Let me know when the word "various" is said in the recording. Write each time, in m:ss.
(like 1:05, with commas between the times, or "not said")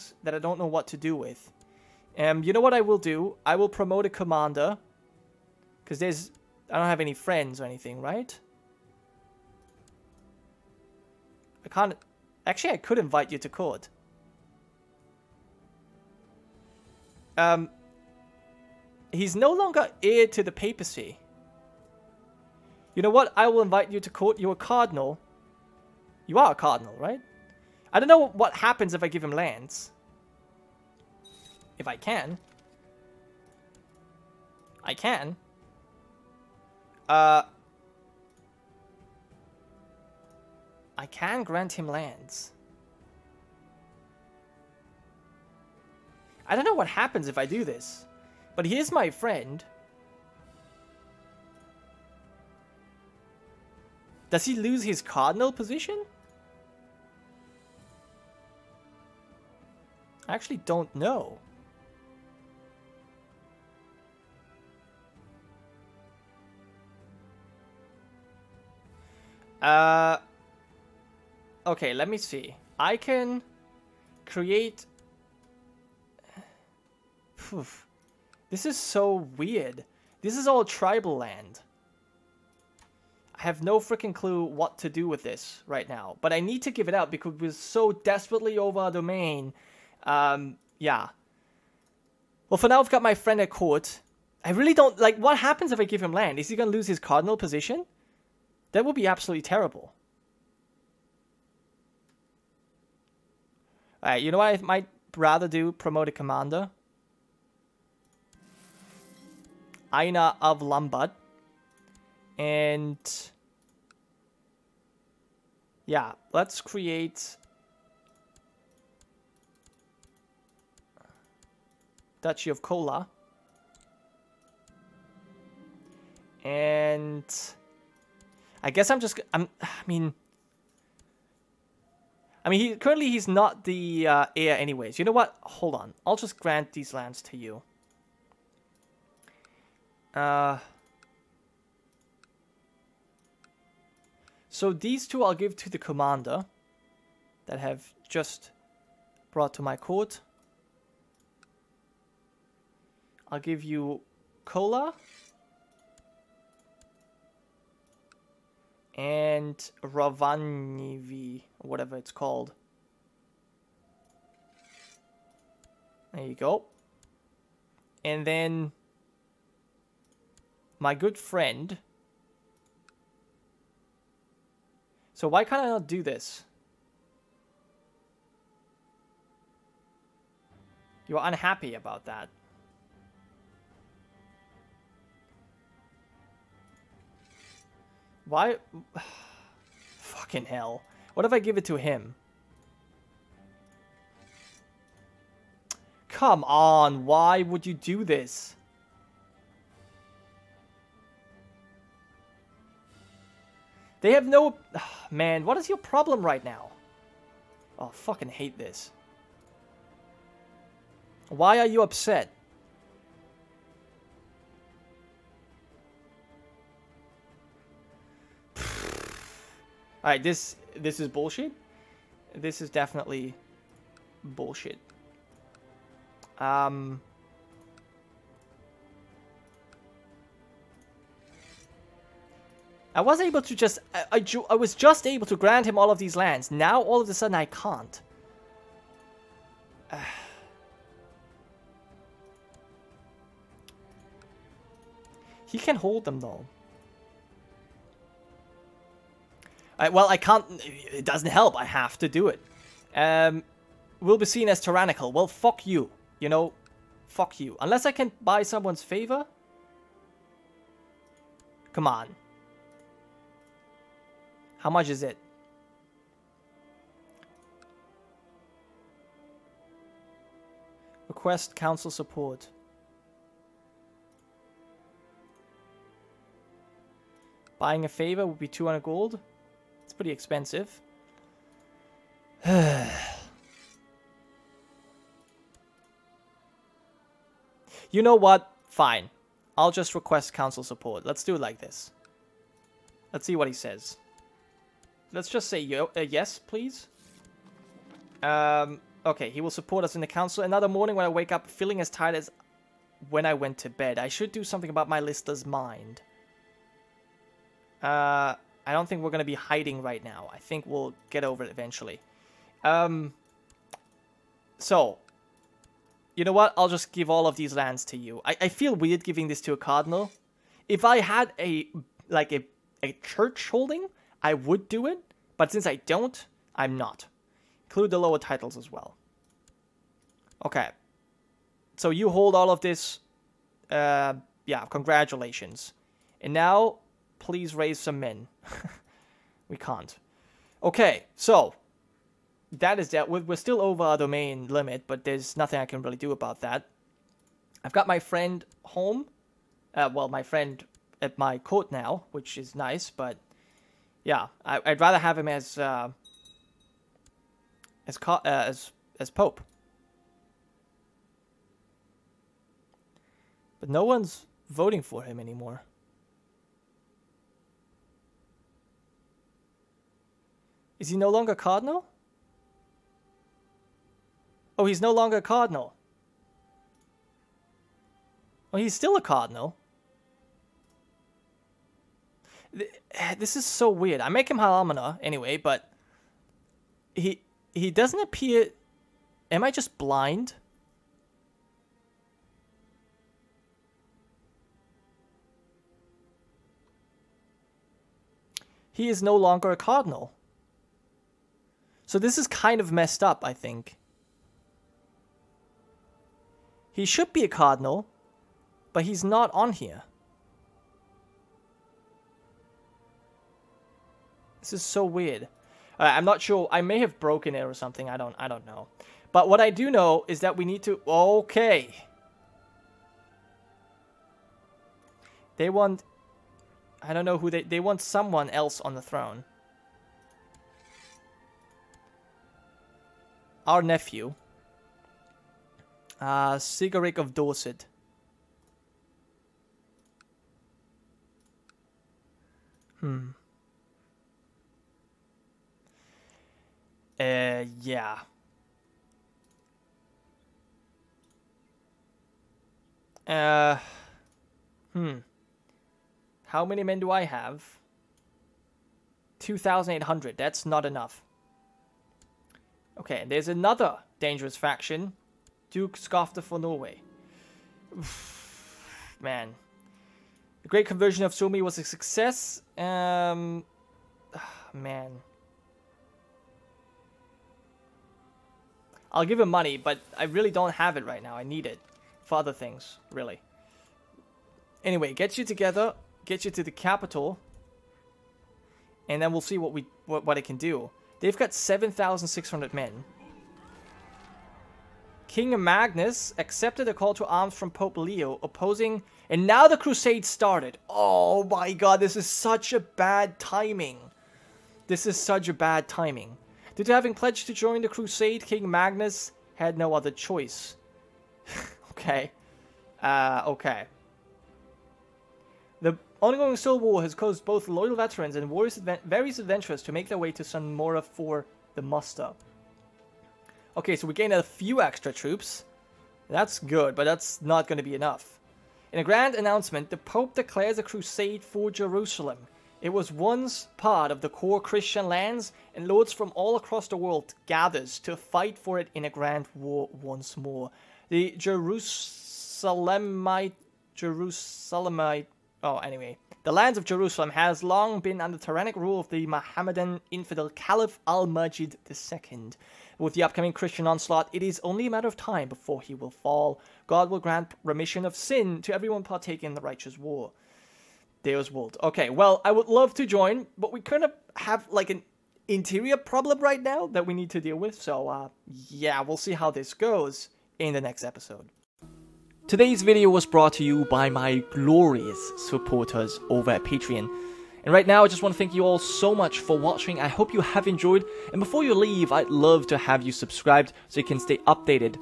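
8:38.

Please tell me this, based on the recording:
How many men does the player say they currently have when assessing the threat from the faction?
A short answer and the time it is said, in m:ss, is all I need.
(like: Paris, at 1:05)
2,800, at 7:39.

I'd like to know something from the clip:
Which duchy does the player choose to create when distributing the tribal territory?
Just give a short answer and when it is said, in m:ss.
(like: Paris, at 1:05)
Duchy of Kola, at 2:02.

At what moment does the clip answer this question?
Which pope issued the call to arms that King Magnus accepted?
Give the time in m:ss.
8:17.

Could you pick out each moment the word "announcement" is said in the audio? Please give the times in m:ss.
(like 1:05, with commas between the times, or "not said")
8:49.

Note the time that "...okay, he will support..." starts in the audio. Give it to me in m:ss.
4:59.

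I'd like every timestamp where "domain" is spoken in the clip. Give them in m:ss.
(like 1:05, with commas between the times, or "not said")
1:28, 5:43.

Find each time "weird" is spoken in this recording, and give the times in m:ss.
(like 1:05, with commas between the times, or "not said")
1:19, 5:18, 6:23, 6:54.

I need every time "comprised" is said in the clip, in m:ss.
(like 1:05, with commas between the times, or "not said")
not said.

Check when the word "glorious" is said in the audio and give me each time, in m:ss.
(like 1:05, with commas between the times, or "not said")
9:34.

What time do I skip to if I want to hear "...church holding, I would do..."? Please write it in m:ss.
5:23.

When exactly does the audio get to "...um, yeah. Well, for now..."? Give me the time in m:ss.
1:30.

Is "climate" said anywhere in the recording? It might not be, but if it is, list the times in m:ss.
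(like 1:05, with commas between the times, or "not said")
not said.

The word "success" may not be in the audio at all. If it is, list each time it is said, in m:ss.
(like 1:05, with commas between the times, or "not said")
7:51.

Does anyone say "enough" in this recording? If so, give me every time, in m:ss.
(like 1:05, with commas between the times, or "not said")
7:40, 8:47.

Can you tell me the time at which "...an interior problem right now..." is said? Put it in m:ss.
9:24.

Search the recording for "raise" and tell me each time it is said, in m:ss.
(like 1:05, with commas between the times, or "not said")
5:37.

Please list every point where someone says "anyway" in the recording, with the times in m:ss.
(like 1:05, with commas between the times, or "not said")
2:14, 6:25, 8:04, 9:05.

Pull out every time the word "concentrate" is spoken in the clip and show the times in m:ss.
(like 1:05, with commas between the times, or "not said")
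not said.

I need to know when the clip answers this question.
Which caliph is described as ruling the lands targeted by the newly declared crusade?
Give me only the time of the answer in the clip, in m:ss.
9:10.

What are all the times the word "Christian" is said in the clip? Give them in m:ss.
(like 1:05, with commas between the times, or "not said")
8:54, 9:13.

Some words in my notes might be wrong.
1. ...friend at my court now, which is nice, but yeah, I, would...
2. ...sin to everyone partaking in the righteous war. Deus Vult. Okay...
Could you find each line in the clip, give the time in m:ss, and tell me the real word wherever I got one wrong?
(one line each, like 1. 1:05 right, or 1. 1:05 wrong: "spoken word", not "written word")
1. 5:50 right
2. 9:17 right.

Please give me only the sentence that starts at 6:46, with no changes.
He should be a cardinal, but he's not on here.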